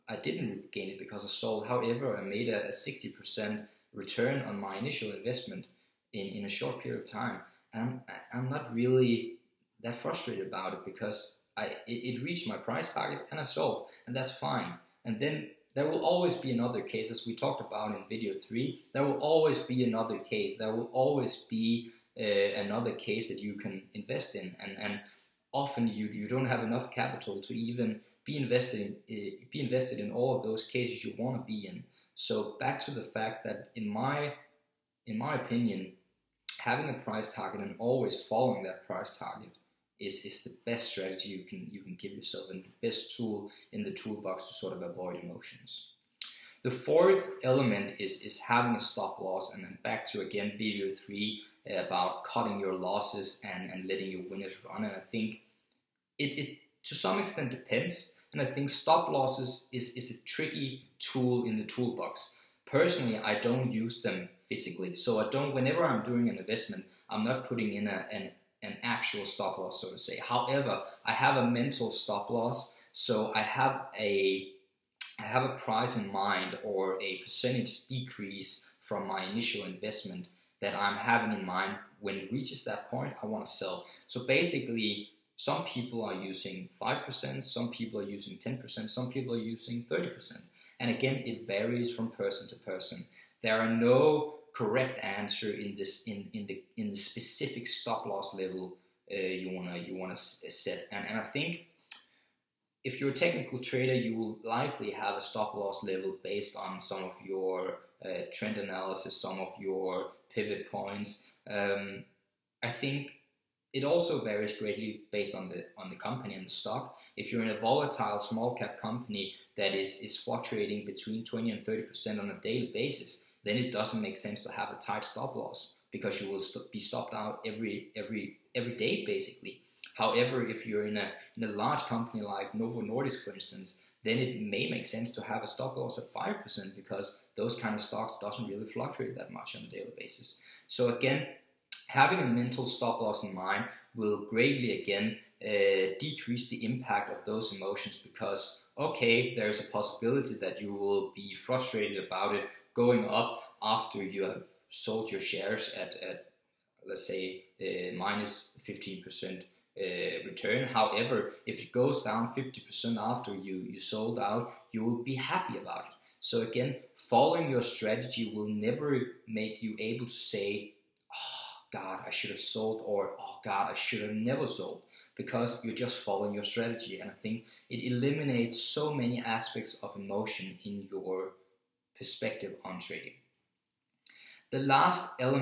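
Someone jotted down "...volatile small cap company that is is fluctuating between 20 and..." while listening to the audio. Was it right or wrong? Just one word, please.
right.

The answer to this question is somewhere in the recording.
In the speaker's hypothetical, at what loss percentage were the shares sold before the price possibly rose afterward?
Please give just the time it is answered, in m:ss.
2:37.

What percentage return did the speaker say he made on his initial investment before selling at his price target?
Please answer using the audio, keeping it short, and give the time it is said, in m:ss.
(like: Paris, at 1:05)
60%, at 0:02.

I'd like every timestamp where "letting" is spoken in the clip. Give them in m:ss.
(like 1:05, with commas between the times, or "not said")
0:53.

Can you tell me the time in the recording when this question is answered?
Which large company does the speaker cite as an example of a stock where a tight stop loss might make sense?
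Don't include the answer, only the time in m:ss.
2:12.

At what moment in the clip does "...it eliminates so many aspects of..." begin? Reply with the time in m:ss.
2:57.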